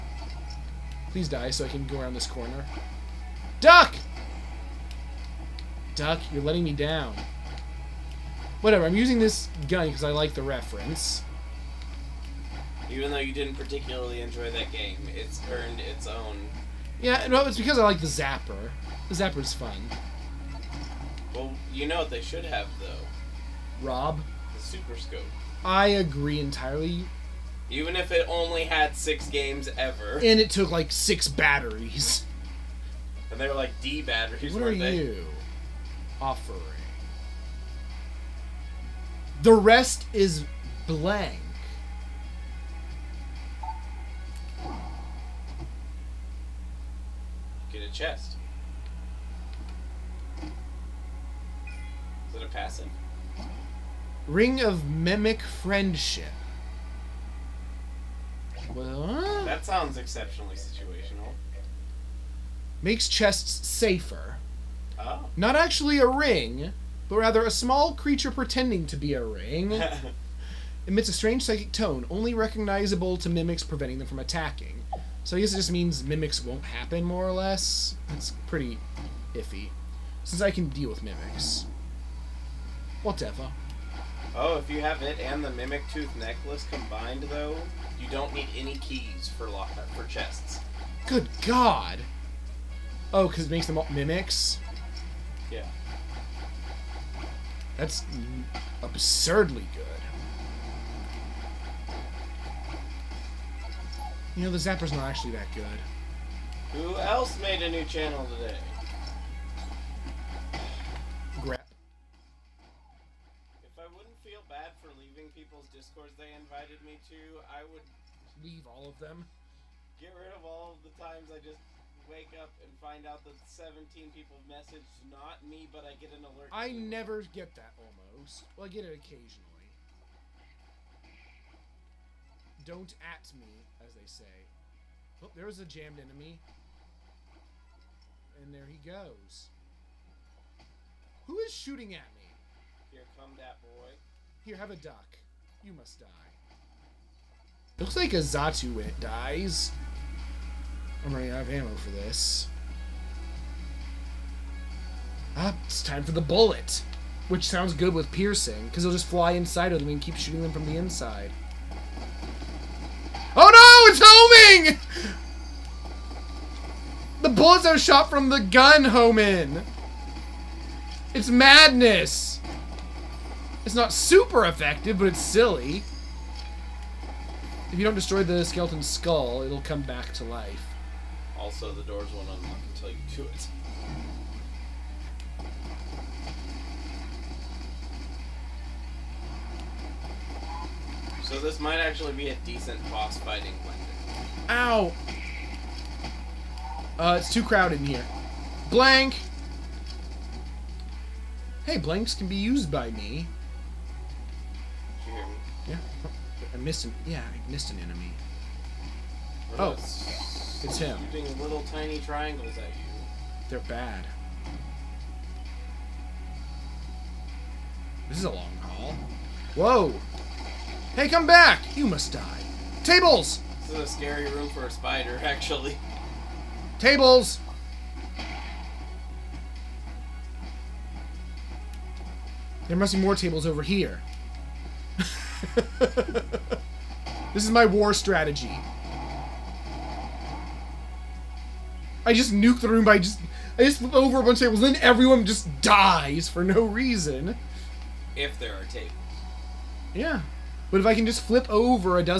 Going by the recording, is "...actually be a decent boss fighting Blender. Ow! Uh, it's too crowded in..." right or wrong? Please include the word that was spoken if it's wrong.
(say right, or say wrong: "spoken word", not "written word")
right.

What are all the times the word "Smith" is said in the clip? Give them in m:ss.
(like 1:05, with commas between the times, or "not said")
not said.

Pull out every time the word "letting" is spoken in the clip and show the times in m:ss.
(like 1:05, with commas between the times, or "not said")
0:06.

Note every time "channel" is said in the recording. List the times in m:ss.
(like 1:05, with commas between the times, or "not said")
1:47.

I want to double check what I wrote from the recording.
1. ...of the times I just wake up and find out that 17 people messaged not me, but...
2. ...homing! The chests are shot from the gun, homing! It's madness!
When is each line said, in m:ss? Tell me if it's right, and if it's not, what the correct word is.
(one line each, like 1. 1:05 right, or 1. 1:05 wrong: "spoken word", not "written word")
1. 2:00 right
2. 2:44 wrong: "bullets", not "chests".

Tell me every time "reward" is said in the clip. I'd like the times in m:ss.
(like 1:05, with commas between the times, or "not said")
not said.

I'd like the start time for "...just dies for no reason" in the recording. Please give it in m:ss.
4:05.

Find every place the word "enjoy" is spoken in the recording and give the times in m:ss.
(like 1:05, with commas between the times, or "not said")
0:14.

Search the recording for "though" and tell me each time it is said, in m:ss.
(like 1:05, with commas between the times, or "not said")
0:13, 0:22, 1:27.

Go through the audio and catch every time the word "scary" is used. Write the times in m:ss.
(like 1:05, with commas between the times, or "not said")
3:43.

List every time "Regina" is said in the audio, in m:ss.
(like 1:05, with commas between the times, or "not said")
not said.